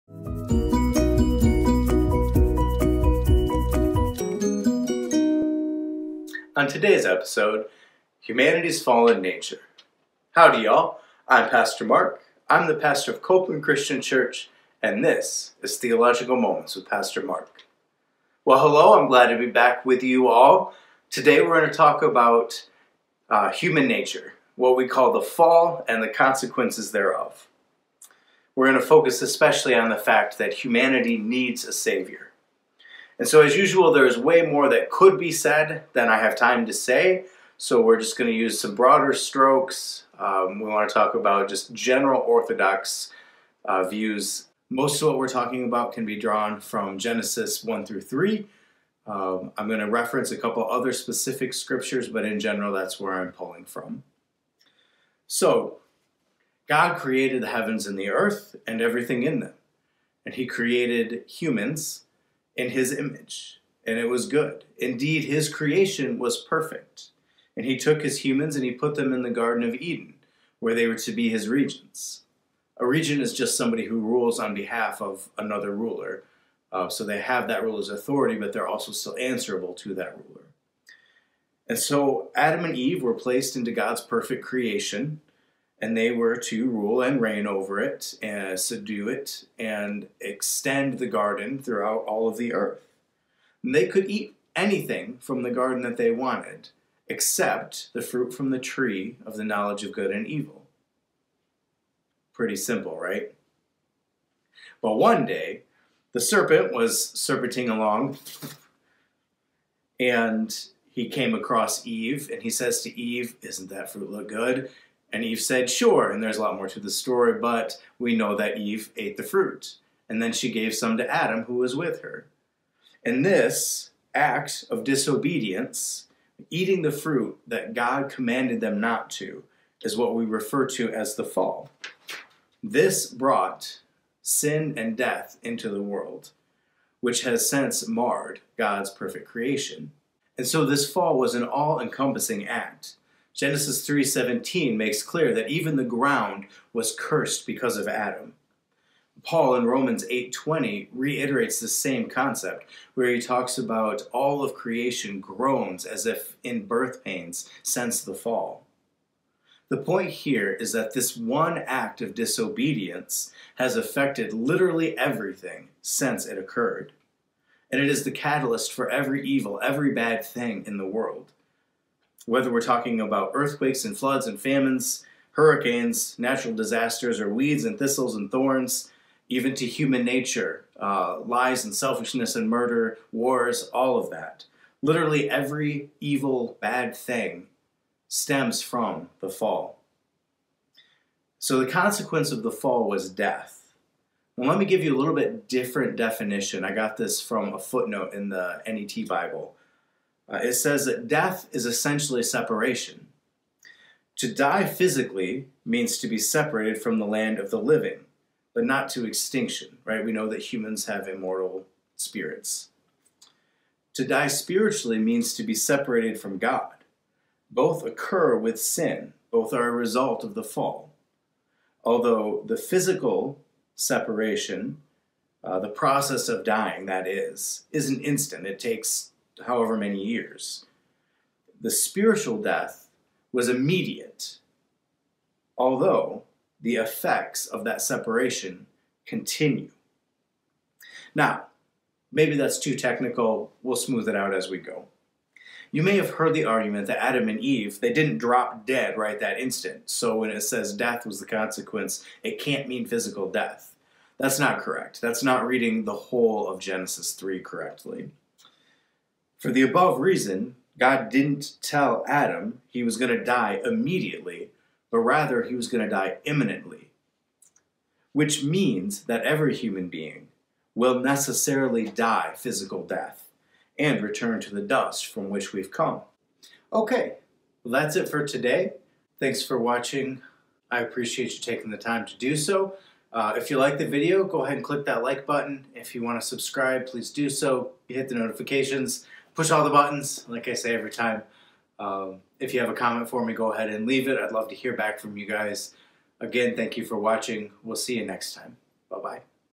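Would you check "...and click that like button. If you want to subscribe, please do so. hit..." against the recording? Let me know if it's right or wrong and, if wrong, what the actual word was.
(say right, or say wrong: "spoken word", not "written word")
right.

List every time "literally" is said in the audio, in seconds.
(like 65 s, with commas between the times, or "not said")
164 s, 184 s.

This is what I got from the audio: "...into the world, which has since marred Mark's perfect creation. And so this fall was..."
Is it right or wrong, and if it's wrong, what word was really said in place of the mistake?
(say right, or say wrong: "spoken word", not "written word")
wrong: "God", not "Mark".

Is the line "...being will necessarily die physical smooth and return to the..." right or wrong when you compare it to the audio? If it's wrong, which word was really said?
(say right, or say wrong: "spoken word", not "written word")
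wrong: "death", not "smooth".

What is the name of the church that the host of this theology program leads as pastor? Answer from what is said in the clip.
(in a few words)
Copeland Christian Church.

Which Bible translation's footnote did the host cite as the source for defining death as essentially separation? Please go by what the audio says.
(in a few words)
NET Bible.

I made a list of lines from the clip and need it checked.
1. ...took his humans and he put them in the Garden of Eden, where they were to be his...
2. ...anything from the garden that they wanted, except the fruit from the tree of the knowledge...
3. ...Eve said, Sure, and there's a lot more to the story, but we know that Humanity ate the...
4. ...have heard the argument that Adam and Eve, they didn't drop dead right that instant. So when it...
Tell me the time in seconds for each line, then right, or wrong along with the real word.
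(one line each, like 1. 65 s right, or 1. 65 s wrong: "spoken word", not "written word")
1. 67 s right
2. 94 s right
3. 115 s wrong: "Eve", not "Humanity"
4. 245 s right.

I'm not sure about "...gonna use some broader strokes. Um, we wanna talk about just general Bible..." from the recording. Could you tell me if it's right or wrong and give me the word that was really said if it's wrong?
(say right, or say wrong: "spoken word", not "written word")
wrong: "Orthodox", not "Bible".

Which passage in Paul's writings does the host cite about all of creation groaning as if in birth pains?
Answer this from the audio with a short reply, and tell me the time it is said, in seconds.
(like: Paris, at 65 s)
Romans 8:20, at 149 s.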